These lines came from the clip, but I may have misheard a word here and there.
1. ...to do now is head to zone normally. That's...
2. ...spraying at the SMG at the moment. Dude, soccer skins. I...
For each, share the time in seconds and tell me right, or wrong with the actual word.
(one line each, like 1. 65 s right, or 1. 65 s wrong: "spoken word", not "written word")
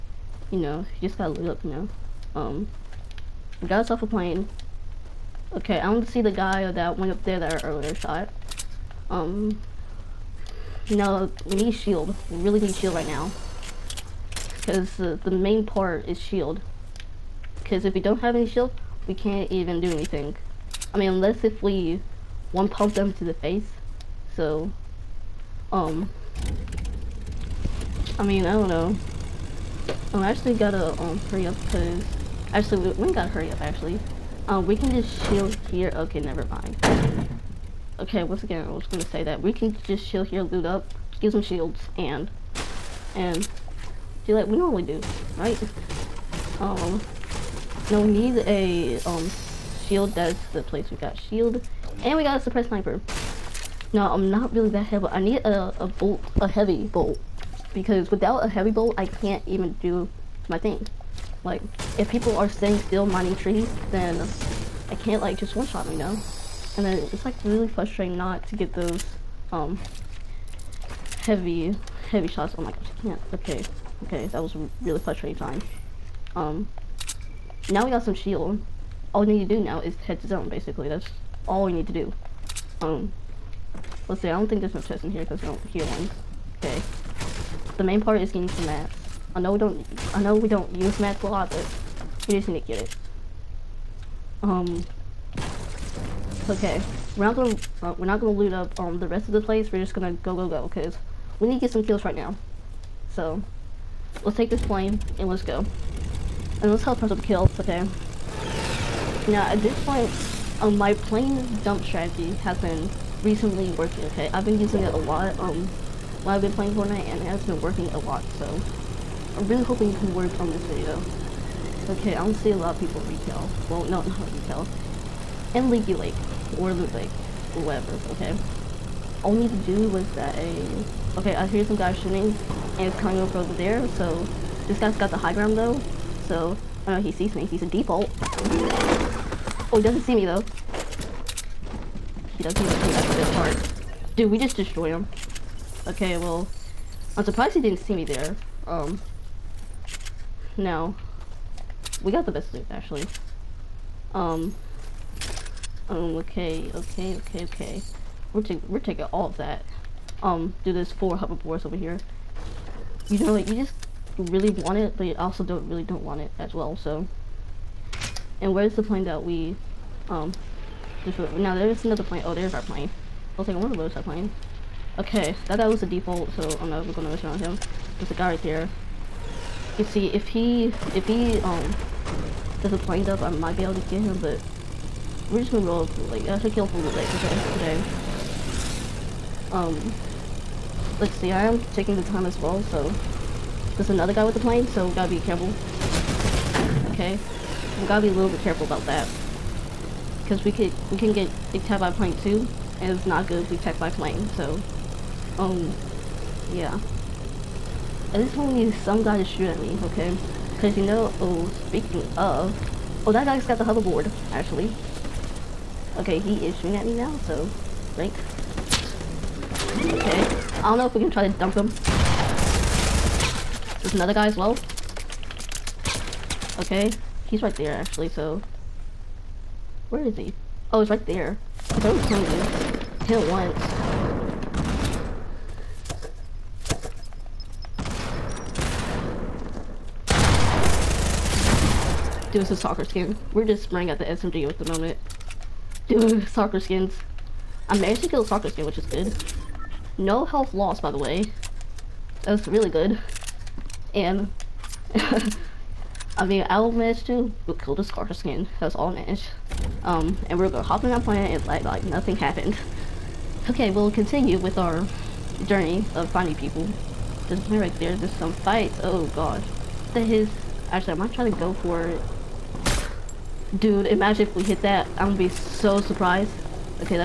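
1. 79 s wrong: "basically", not "normally"
2. 243 s right.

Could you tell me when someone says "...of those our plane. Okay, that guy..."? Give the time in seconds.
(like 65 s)
173 s.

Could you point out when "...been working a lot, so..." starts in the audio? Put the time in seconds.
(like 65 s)
117 s.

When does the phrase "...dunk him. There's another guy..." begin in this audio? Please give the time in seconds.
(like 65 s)
221 s.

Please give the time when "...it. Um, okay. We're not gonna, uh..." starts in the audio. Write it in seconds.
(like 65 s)
92 s.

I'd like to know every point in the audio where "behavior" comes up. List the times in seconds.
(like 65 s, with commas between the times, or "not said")
not said.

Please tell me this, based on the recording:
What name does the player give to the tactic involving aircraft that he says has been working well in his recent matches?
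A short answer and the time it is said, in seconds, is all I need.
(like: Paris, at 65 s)
plane dump strategy, at 110 s.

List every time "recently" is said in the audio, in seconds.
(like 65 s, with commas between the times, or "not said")
113 s.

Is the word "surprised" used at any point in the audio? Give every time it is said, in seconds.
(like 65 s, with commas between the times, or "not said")
147 s, 275 s.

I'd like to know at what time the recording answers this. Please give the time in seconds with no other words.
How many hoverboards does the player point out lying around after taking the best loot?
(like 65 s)
160 s.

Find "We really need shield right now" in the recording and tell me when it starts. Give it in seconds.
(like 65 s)
12 s.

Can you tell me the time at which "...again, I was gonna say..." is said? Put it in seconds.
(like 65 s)
38 s.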